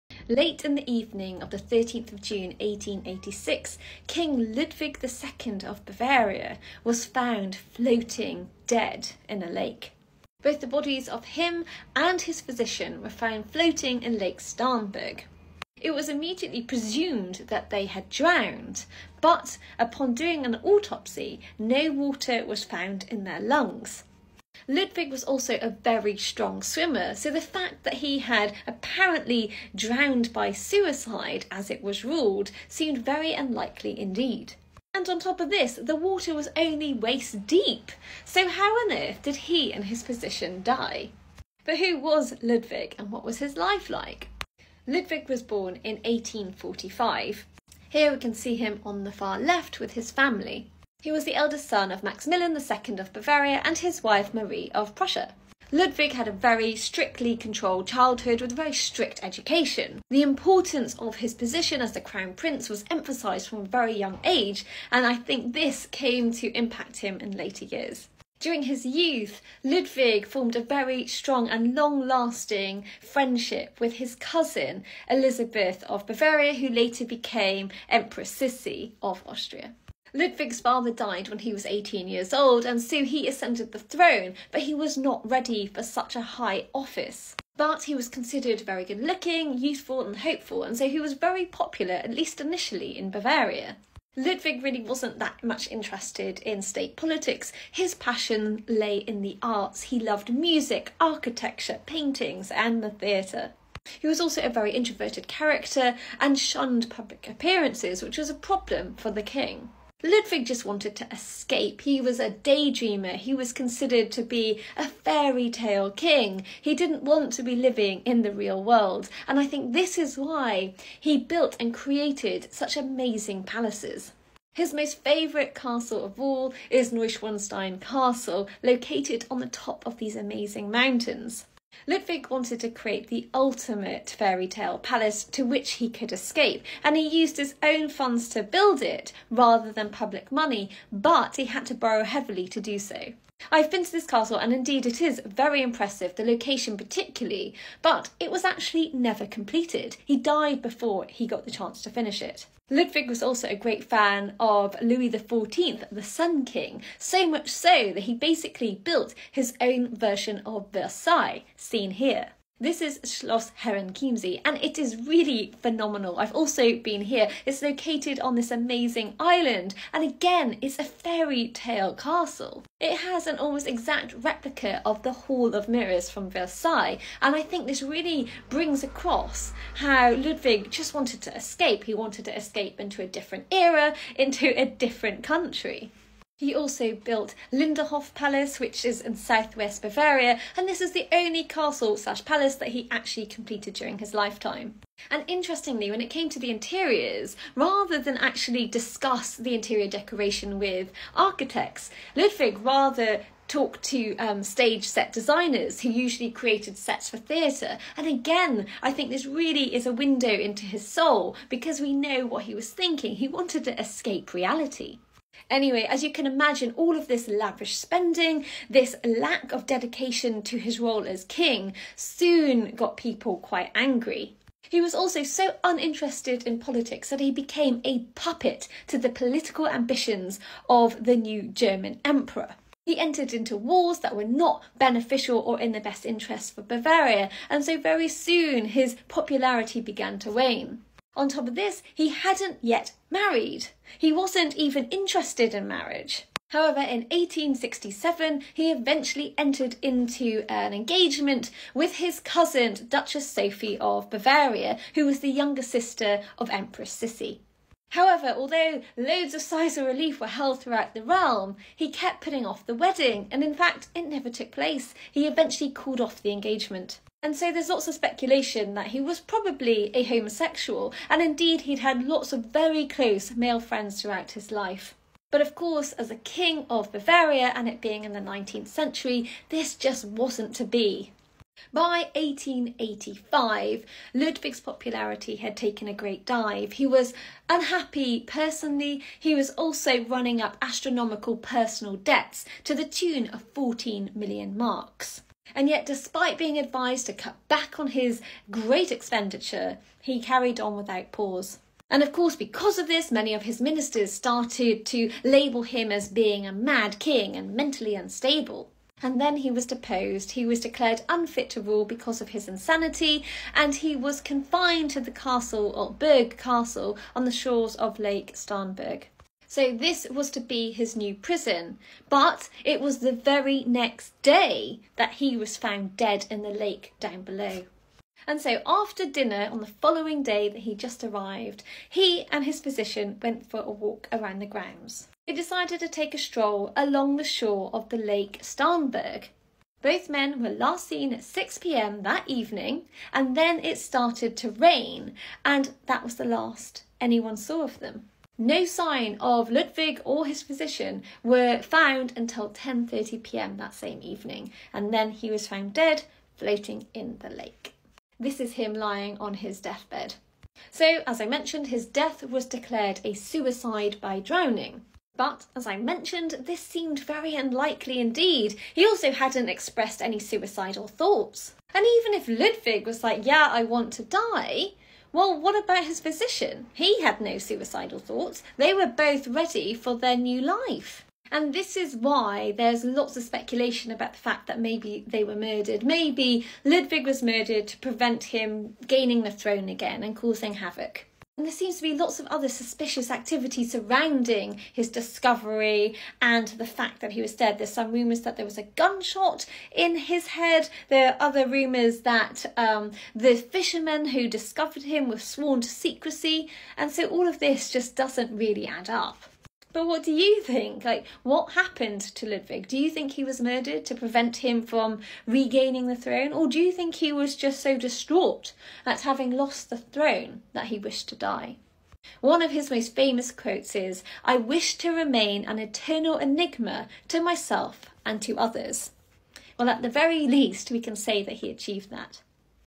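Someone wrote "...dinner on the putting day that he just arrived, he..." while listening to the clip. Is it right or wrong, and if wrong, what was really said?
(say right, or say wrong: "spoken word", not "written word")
wrong: "following", not "putting".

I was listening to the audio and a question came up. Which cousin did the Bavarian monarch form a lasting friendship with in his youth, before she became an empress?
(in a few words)
Elizabeth of Bavaria.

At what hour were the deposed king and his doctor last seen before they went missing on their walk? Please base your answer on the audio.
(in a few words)
6pm.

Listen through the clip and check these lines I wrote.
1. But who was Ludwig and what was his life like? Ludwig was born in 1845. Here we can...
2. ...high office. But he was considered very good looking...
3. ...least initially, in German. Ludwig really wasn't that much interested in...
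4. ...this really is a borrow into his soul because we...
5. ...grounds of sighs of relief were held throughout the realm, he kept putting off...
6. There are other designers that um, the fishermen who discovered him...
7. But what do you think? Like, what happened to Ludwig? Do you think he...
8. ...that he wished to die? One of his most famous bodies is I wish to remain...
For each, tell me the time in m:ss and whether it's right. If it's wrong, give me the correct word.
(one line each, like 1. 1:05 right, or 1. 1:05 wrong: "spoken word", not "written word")
1. 0:41 right
2. 1:26 right
3. 1:32 wrong: "Bavaria", not "German"
4. 3:29 wrong: "window", not "borrow"
5. 4:18 wrong: "loads", not "grounds"
6. 6:40 wrong: "rumours", not "designers"
7. 6:49 right
8. 7:00 wrong: "quotes", not "bodies".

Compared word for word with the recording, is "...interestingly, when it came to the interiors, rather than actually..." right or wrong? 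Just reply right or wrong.
right.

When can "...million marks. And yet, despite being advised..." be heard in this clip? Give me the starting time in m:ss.
4:54.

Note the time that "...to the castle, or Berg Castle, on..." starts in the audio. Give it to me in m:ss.
5:14.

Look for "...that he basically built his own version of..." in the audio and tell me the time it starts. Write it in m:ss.
2:37.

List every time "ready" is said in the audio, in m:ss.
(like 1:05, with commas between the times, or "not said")
1:25, 6:19.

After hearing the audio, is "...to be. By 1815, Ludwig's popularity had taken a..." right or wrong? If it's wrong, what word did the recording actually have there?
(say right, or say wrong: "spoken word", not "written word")
wrong: "1885", not "1815".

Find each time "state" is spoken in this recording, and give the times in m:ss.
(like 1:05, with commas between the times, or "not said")
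1:36.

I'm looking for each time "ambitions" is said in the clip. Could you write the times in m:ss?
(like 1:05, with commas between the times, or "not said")
3:49.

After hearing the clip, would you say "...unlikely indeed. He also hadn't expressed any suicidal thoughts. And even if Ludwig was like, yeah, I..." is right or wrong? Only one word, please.
right.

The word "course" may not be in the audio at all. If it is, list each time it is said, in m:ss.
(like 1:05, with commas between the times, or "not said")
4:35, 5:02.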